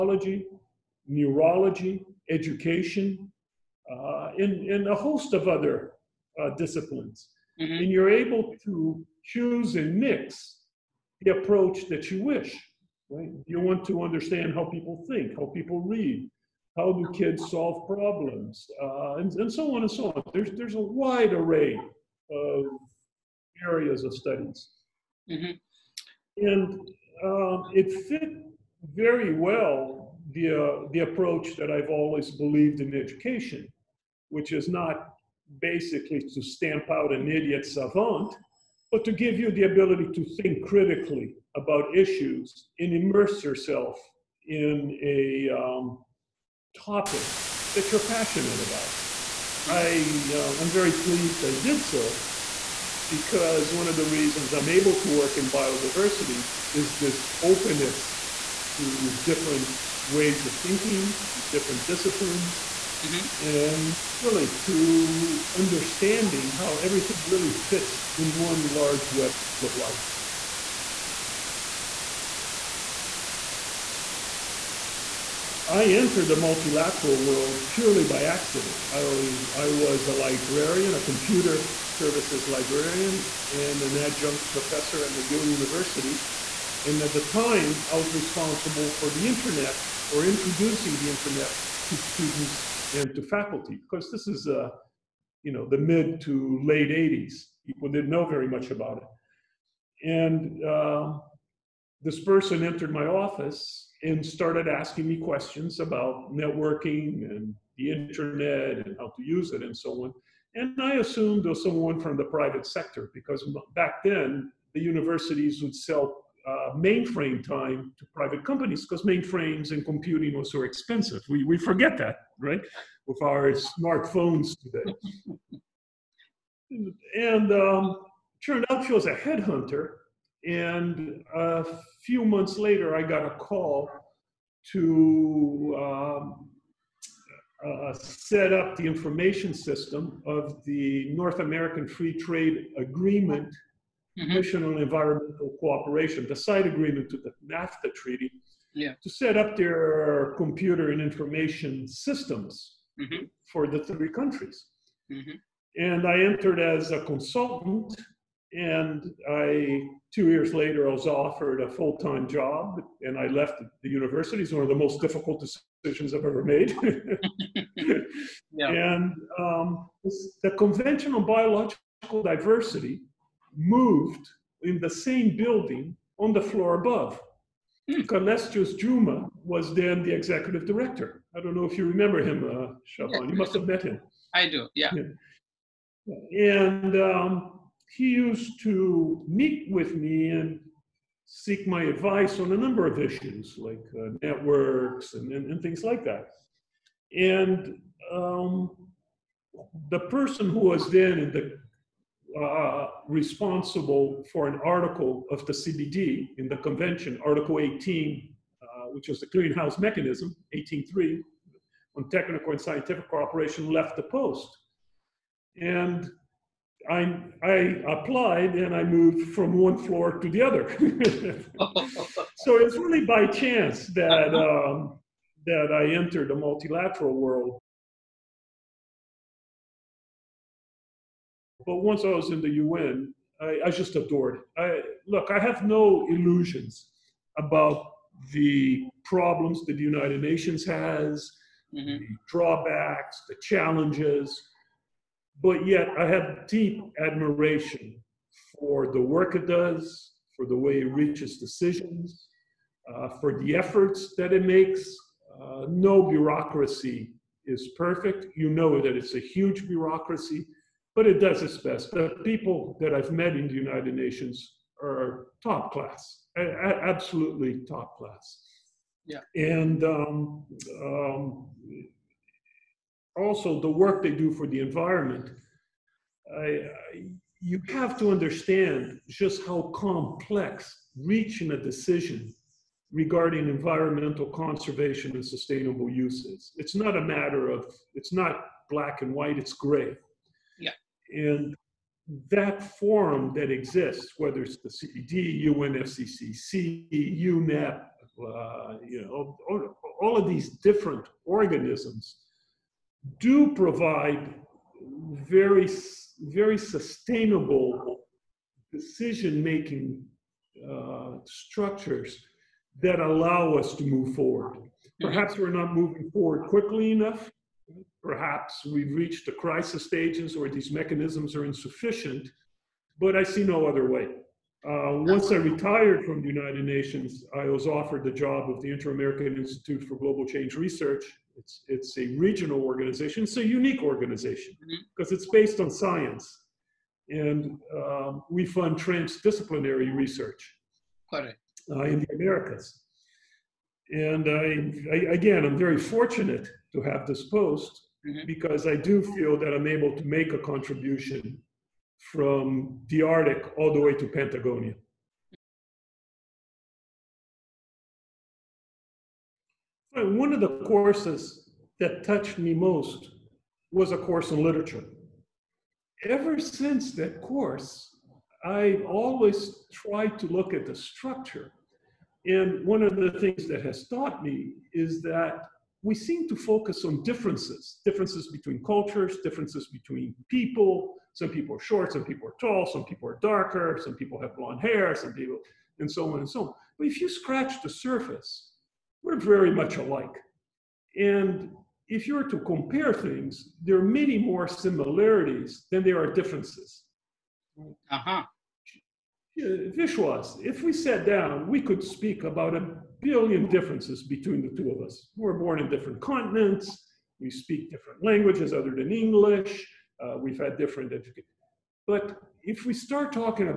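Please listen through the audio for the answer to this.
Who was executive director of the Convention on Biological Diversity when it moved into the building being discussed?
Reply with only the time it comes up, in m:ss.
2:58.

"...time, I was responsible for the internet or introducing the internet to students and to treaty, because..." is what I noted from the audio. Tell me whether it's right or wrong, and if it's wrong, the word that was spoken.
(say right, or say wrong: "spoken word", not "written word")
wrong: "faculty", not "treaty".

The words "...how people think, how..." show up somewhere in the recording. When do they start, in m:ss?
0:14.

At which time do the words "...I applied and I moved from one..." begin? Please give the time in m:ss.
3:37.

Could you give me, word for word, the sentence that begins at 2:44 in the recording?
It's one of the most difficult decisions I've ever made.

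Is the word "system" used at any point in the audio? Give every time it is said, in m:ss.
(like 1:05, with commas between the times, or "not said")
2:19, 2:31.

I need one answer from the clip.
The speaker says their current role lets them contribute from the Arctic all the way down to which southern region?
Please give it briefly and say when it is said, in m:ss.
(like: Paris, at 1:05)
Patagonia, at 5:54.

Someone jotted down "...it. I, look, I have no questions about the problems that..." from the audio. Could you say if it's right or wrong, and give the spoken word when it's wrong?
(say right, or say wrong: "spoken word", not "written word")
wrong: "illusions", not "questions".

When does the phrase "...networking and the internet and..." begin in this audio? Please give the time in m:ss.
1:46.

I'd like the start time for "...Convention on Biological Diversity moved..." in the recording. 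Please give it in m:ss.
2:50.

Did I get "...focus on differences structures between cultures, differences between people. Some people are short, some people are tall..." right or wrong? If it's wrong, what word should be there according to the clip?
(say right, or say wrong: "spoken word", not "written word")
wrong: "differences", not "structures".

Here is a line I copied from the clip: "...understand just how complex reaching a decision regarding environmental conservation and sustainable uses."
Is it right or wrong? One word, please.
right.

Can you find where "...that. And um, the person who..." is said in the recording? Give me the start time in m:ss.
3:16.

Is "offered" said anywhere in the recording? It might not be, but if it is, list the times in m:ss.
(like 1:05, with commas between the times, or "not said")
2:41, 5:27.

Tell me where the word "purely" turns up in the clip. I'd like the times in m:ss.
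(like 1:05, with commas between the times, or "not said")
1:17.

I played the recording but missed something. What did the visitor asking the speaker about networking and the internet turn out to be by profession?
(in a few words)
Headhunter.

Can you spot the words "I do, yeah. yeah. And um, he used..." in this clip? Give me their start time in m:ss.
3:04.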